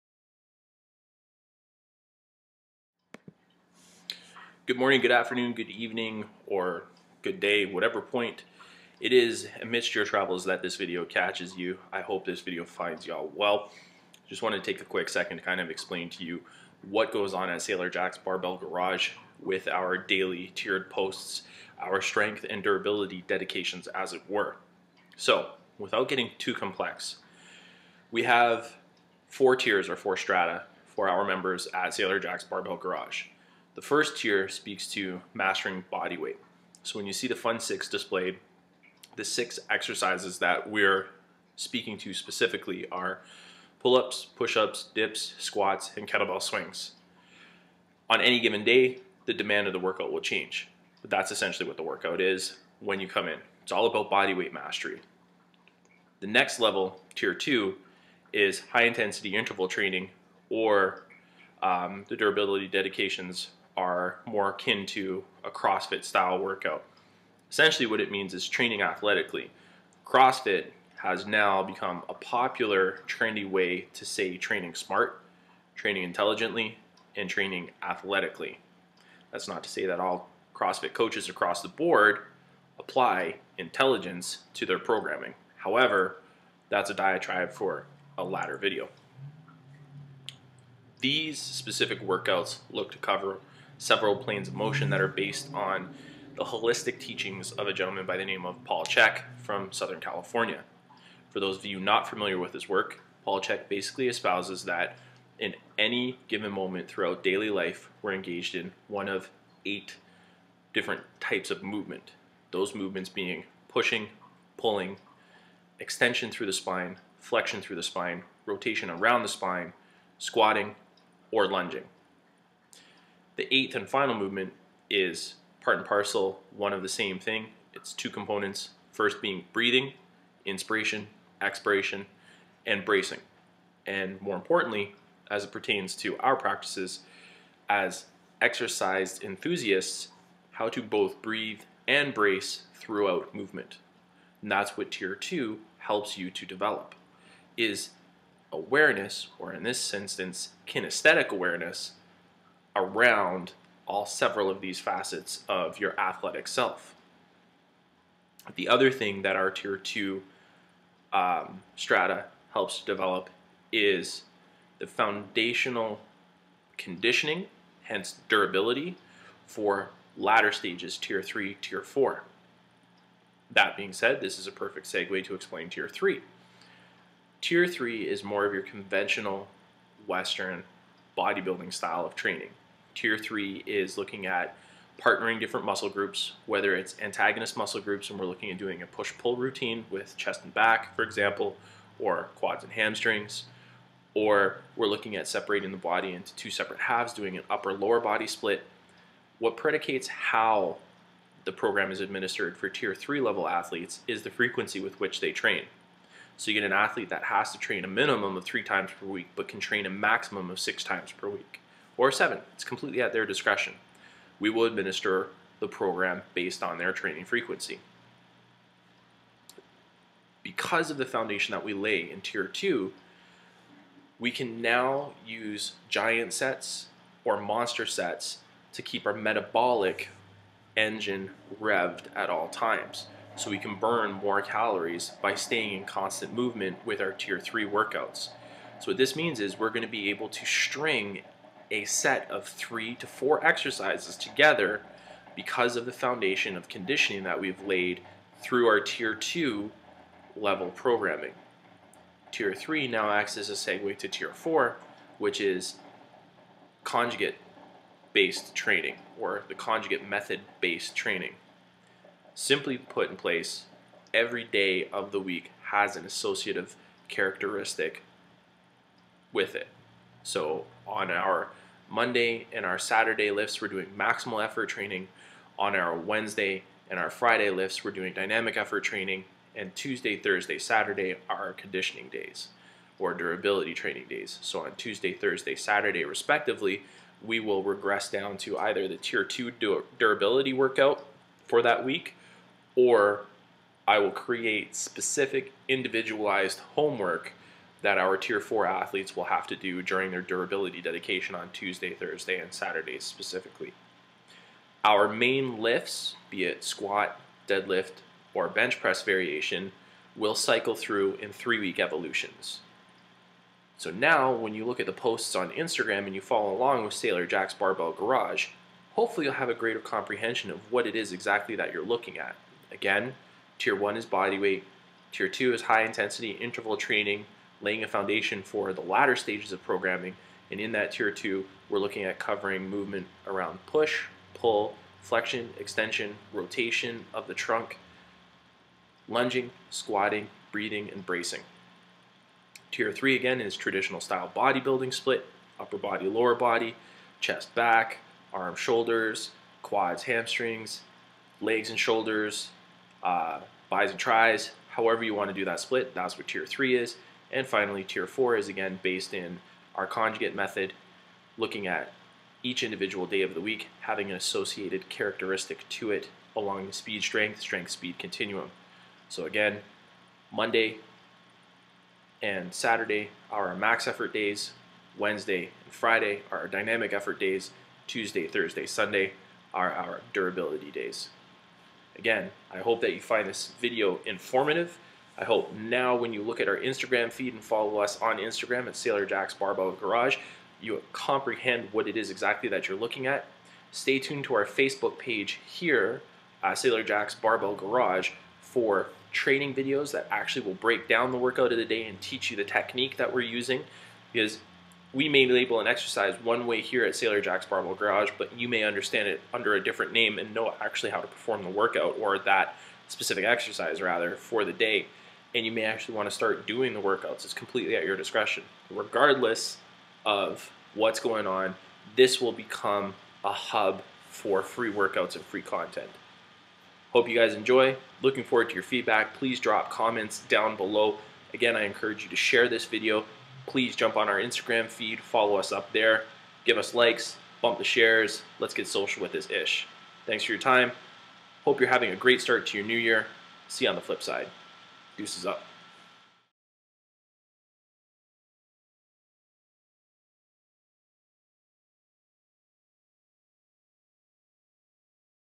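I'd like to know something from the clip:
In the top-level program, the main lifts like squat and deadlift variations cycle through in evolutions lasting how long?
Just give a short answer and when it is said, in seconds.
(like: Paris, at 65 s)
3 weeks, at 311 s.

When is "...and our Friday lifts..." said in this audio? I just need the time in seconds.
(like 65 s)
276 s.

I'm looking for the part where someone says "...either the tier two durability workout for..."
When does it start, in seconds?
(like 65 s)
288 s.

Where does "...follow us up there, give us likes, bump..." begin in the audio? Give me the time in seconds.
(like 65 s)
434 s.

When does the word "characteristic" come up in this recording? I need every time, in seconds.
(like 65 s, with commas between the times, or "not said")
267 s, 364 s.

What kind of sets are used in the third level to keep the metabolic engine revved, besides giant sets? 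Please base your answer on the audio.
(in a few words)
monster sets.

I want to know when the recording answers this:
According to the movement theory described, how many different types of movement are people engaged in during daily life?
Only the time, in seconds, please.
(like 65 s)
109 s.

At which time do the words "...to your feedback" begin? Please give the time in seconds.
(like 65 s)
428 s.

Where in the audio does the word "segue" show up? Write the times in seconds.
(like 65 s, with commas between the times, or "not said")
174 s, 253 s.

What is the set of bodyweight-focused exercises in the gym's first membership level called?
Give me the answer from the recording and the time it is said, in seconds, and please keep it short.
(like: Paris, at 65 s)
Fun 6, at 37 s.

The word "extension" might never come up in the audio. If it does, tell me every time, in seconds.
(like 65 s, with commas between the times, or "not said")
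115 s, 335 s.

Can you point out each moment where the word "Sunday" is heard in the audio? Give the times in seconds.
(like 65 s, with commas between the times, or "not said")
378 s.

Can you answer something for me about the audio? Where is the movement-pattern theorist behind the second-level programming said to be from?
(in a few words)
Southern California.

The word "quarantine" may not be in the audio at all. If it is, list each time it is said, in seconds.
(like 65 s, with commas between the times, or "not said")
not said.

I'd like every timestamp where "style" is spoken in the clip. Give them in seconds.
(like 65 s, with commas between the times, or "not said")
66 s, 181 s, 344 s.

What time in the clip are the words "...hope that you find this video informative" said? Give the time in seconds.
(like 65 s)
382 s.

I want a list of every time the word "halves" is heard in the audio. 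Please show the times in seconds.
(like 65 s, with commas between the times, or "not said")
196 s.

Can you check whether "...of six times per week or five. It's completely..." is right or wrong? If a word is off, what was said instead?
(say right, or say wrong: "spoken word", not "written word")
wrong: "seven", not "five".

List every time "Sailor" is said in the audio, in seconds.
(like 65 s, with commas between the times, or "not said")
17 s, 31 s, 316 s, 388 s, 396 s, 406 s.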